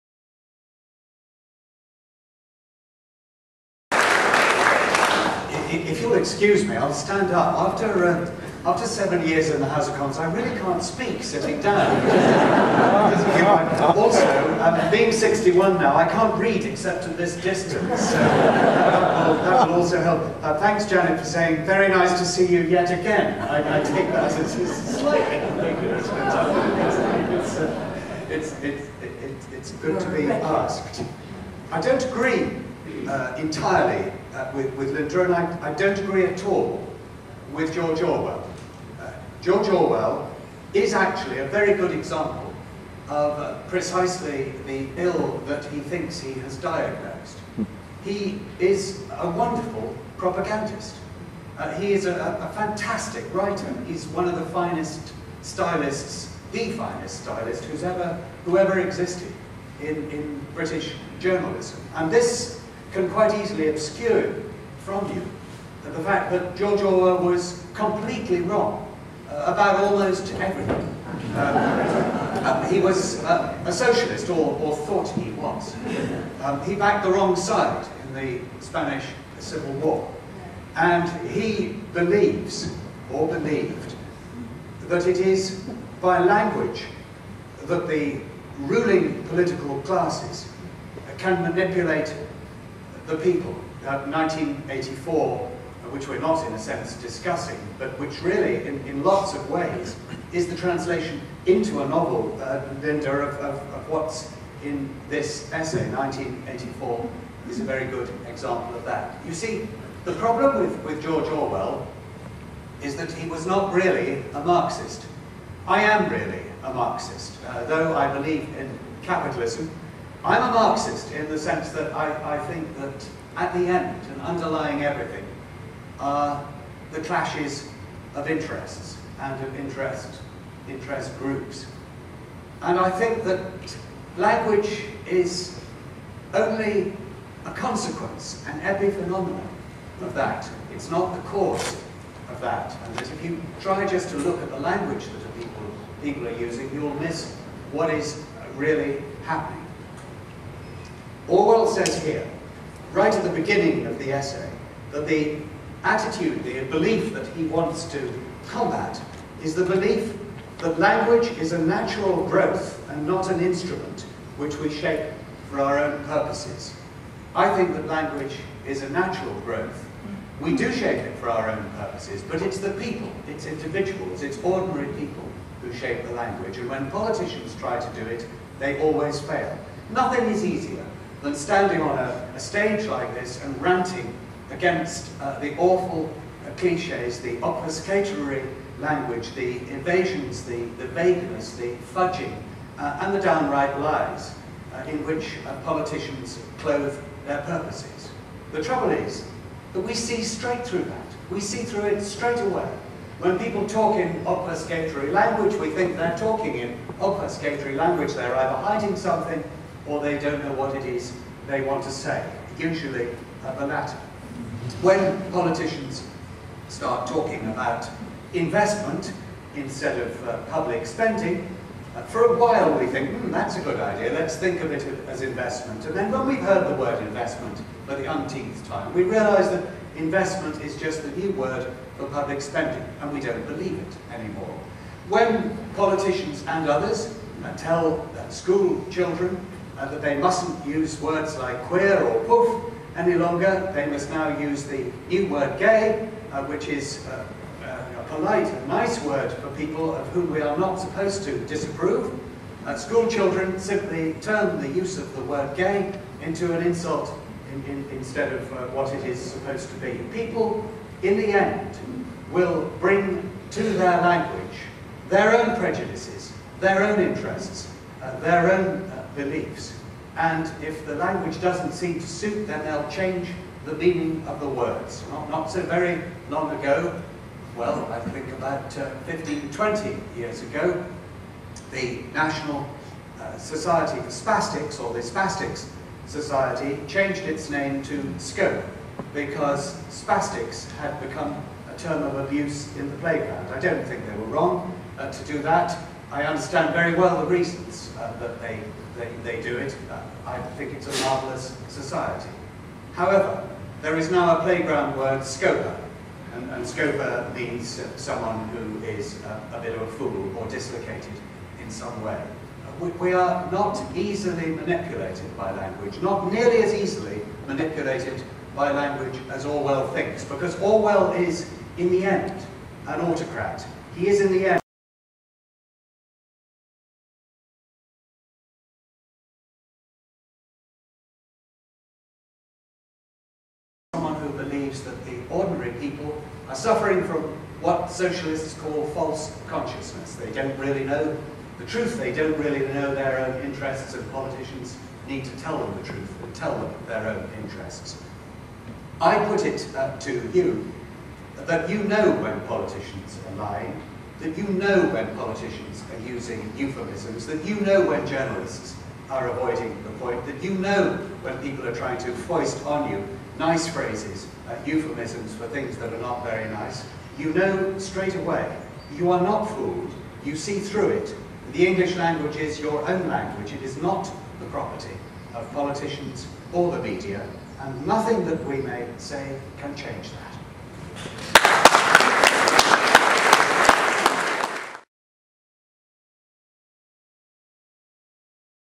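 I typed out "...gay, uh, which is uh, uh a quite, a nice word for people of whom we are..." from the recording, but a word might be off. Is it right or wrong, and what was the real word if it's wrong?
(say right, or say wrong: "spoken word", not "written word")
wrong: "polite", not "quite".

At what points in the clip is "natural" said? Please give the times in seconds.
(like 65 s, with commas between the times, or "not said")
161 s, 168 s.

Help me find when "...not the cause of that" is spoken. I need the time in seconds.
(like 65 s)
140 s.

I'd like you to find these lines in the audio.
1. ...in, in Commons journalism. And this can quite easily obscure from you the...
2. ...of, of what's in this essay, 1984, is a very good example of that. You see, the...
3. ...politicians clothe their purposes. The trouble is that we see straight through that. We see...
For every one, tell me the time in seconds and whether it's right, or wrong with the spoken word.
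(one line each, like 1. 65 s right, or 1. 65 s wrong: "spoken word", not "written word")
1. 59 s wrong: "British", not "Commons"
2. 103 s right
3. 195 s right.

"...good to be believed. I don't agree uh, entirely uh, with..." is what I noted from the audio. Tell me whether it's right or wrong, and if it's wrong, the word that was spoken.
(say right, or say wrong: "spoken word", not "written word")
wrong: "asked", not "believed".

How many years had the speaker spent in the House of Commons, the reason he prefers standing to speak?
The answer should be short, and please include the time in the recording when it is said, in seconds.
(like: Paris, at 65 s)
7, at 8 s.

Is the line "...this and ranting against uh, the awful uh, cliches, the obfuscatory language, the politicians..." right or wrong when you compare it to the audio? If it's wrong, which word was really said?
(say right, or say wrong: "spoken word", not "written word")
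wrong: "evasions", not "politicians".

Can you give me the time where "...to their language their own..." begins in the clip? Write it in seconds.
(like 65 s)
263 s.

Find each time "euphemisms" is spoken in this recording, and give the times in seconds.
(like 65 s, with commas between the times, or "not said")
356 s, 364 s.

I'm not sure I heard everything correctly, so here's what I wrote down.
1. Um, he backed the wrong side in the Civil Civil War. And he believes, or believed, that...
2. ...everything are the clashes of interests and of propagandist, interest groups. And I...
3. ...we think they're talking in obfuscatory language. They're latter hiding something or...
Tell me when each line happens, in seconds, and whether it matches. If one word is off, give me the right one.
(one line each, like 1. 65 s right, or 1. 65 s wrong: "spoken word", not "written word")
1. 76 s wrong: "Spanish", not "Civil"
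2. 124 s wrong: "interest", not "propagandist"
3. 205 s wrong: "either", not "latter".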